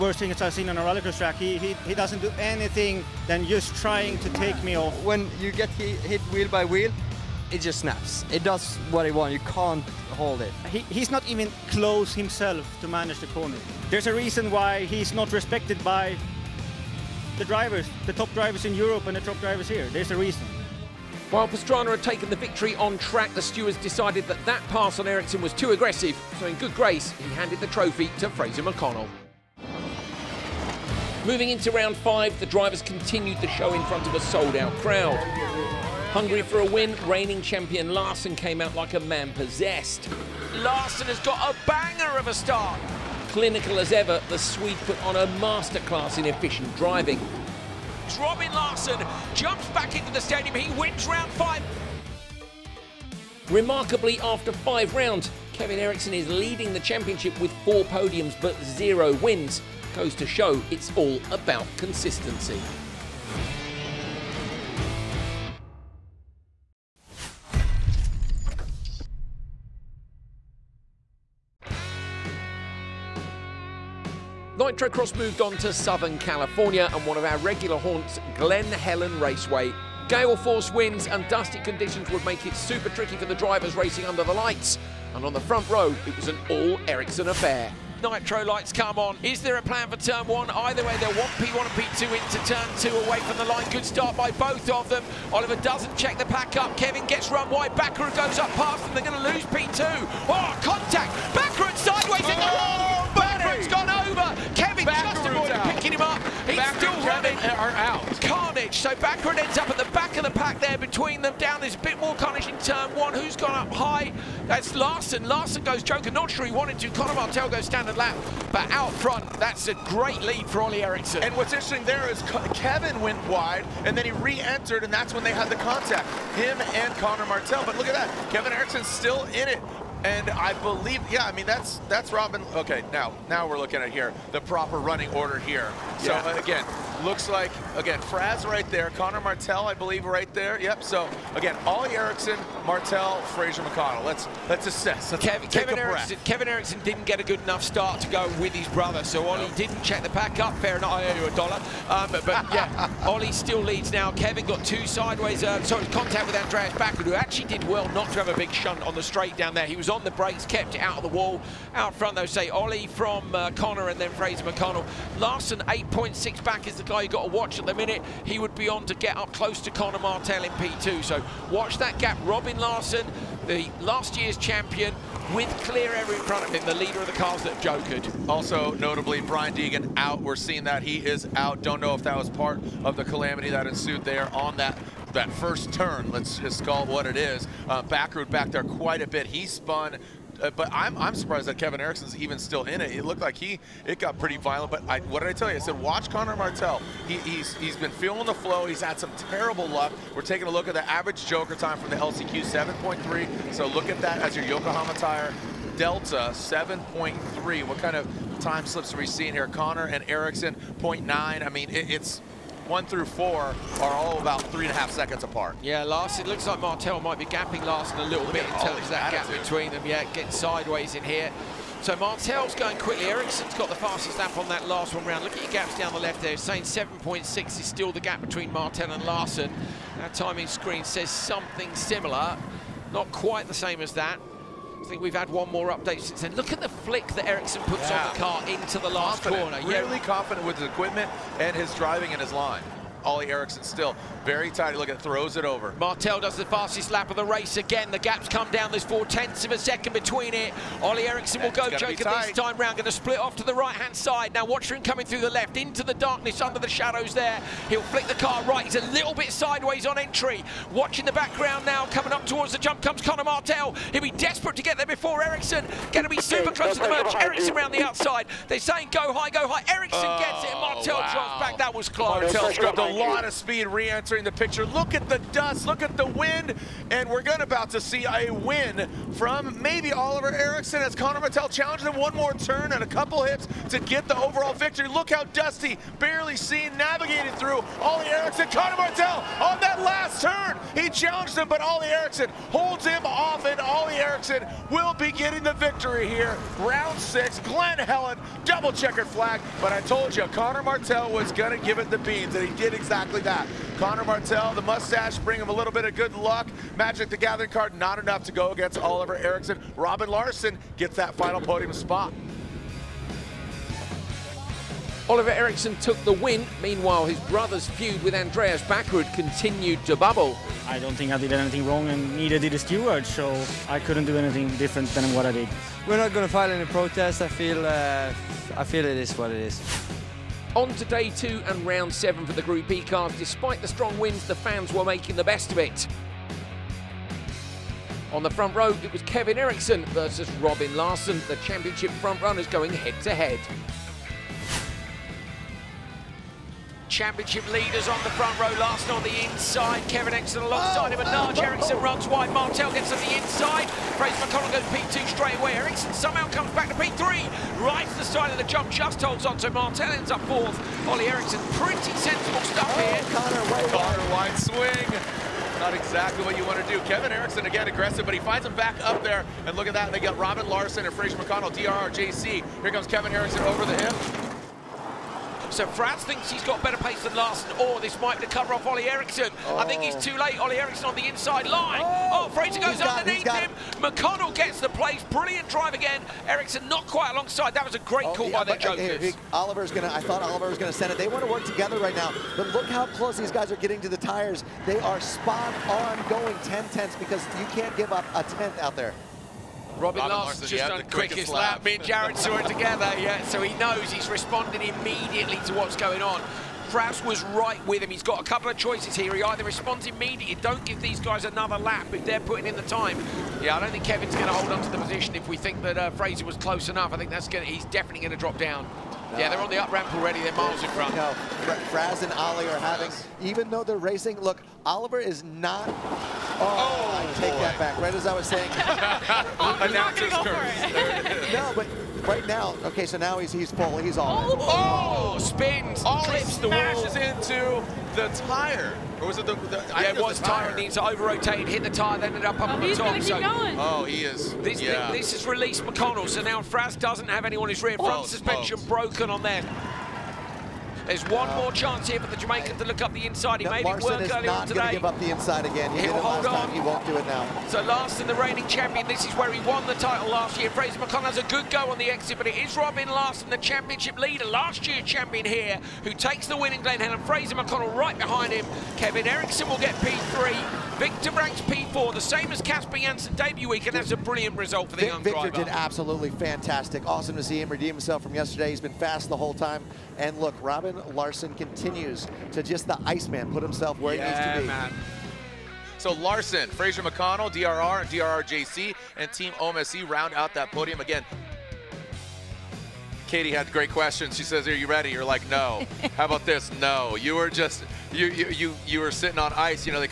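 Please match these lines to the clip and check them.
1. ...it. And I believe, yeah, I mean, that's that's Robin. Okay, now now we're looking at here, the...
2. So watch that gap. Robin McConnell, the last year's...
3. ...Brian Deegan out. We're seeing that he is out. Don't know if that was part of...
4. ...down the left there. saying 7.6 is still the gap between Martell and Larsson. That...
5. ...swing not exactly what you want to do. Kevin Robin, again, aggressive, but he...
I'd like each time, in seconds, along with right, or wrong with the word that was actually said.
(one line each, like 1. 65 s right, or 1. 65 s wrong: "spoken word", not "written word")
1. 129 s right
2. 171 s wrong: "Larsson", not "McConnell"
3. 179 s right
4. 225 s right
5. 364 s wrong: "Eriksson", not "Robin".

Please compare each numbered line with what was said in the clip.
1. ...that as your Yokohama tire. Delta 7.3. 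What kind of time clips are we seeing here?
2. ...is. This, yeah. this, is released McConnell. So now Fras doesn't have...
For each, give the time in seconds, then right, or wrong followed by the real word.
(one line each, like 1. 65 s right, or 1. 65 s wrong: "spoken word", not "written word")
1. 204 s wrong: "slips", not "clips"
2. 444 s right.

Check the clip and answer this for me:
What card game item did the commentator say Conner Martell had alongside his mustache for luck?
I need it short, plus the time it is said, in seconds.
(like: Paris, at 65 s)
Magic the Gathering card, at 306 s.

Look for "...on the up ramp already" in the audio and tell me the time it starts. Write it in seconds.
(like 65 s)
419 s.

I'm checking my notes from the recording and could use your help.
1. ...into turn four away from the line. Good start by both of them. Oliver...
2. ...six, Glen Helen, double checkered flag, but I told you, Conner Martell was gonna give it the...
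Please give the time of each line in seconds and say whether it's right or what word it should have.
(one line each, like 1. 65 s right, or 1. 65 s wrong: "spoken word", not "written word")
1. 92 s wrong: "two", not "four"
2. 296 s right.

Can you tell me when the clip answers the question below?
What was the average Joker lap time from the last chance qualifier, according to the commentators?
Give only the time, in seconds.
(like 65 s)
200 s.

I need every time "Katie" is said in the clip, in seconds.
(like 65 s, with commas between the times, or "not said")
493 s.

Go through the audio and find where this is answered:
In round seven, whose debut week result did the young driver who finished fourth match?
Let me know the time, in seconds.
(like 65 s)
472 s.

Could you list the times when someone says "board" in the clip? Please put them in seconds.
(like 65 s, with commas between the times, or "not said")
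not said.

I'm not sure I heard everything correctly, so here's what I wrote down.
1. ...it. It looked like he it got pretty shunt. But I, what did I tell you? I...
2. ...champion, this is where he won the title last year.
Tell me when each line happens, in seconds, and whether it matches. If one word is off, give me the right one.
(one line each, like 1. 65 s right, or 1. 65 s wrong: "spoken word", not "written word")
1. 192 s wrong: "violent", not "shunt"
2. 458 s right.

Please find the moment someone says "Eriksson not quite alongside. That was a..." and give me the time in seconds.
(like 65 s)
386 s.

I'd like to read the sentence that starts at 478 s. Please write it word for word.
He's been fast the whole time.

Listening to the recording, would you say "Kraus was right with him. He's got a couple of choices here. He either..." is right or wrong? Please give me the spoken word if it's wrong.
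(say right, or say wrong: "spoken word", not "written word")
right.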